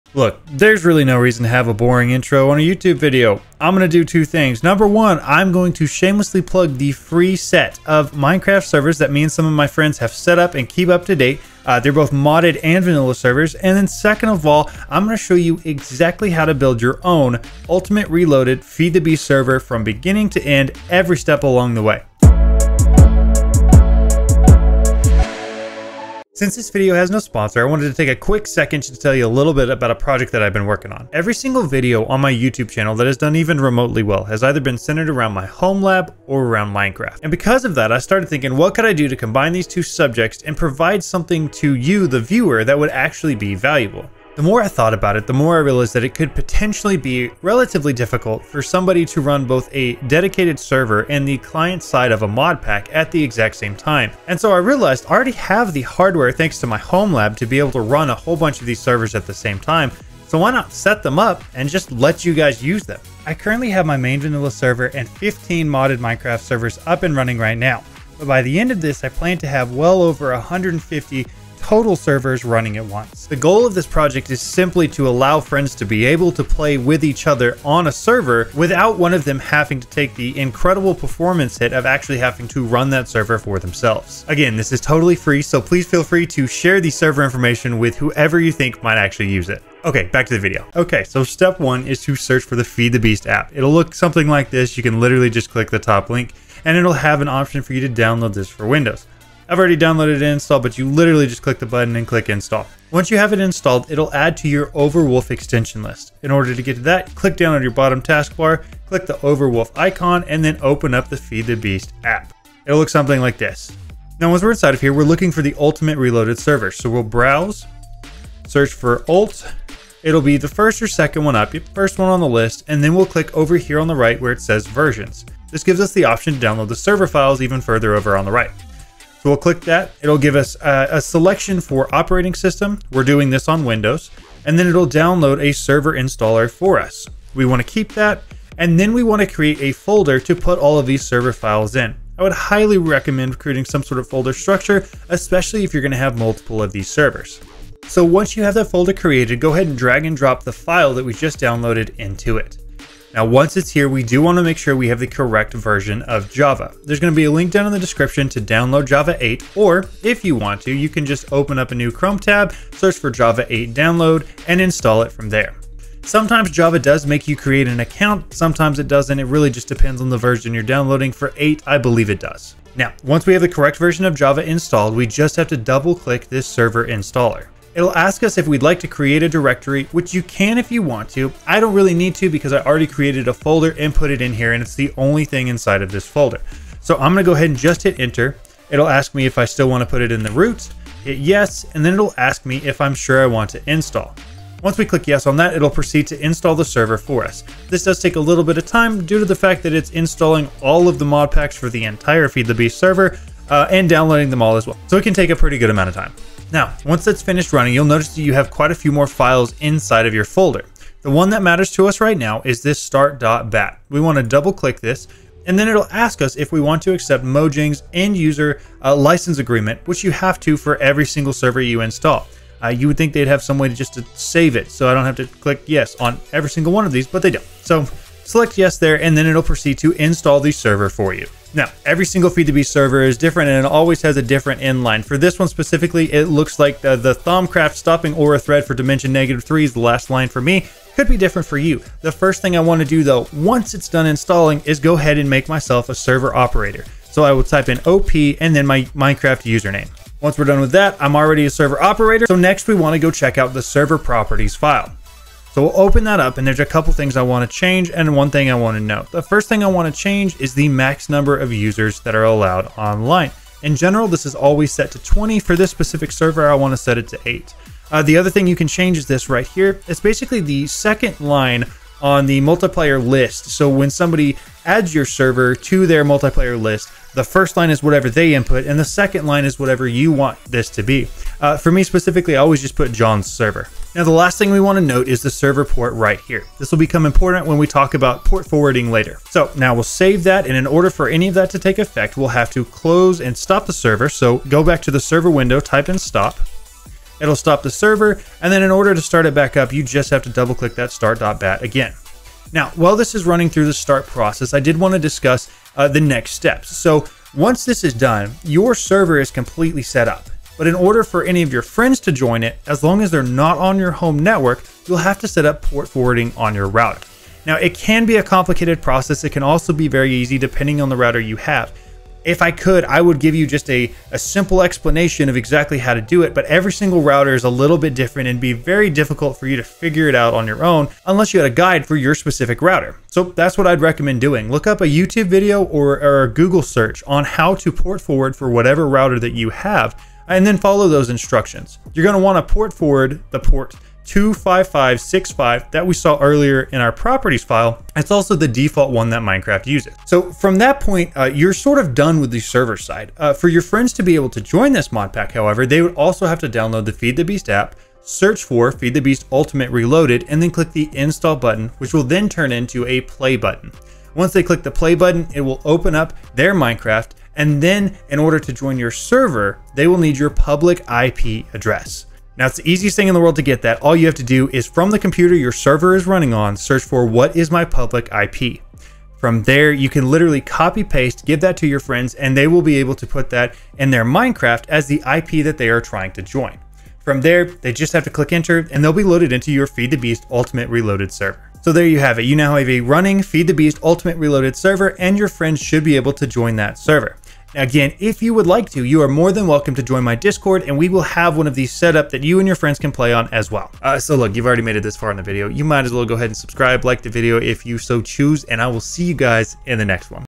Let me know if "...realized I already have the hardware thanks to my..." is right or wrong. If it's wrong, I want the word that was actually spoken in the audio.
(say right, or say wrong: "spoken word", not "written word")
right.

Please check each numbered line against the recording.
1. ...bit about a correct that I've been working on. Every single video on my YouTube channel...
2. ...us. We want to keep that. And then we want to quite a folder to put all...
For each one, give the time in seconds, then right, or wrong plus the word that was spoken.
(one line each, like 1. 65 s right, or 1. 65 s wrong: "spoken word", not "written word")
1. 29 s wrong: "project", not "correct"
2. 136 s wrong: "create", not "quite".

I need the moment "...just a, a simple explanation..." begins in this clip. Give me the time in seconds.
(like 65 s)
323 s.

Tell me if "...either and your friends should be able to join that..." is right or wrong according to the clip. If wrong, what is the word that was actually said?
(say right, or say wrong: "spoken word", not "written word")
wrong: "server", not "either".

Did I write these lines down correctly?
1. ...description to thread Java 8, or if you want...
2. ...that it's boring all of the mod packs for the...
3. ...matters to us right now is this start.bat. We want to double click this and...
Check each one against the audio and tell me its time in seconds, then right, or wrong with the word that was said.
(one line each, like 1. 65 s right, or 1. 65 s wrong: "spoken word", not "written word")
1. 157 s wrong: "download", not "thread"
2. 199 s wrong: "installing", not "boring"
3. 211 s right.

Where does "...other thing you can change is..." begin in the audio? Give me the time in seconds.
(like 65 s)
268 s.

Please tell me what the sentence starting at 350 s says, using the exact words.
So from that point, uh, you're sort of done with the server side.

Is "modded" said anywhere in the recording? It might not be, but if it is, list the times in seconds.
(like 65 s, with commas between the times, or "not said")
12 s, 65 s.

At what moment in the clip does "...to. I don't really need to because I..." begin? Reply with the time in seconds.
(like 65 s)
181 s.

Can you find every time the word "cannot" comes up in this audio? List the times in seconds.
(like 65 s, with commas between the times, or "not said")
not said.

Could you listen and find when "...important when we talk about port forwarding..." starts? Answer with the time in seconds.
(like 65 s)
287 s.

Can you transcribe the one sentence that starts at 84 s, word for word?
Again, this is totally free, so please feel free to share the server information with whoever you think might actually use it.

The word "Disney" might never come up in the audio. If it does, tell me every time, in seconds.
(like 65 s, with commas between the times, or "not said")
not said.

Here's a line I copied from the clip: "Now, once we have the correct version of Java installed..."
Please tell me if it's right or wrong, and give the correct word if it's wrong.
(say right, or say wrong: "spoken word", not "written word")
right.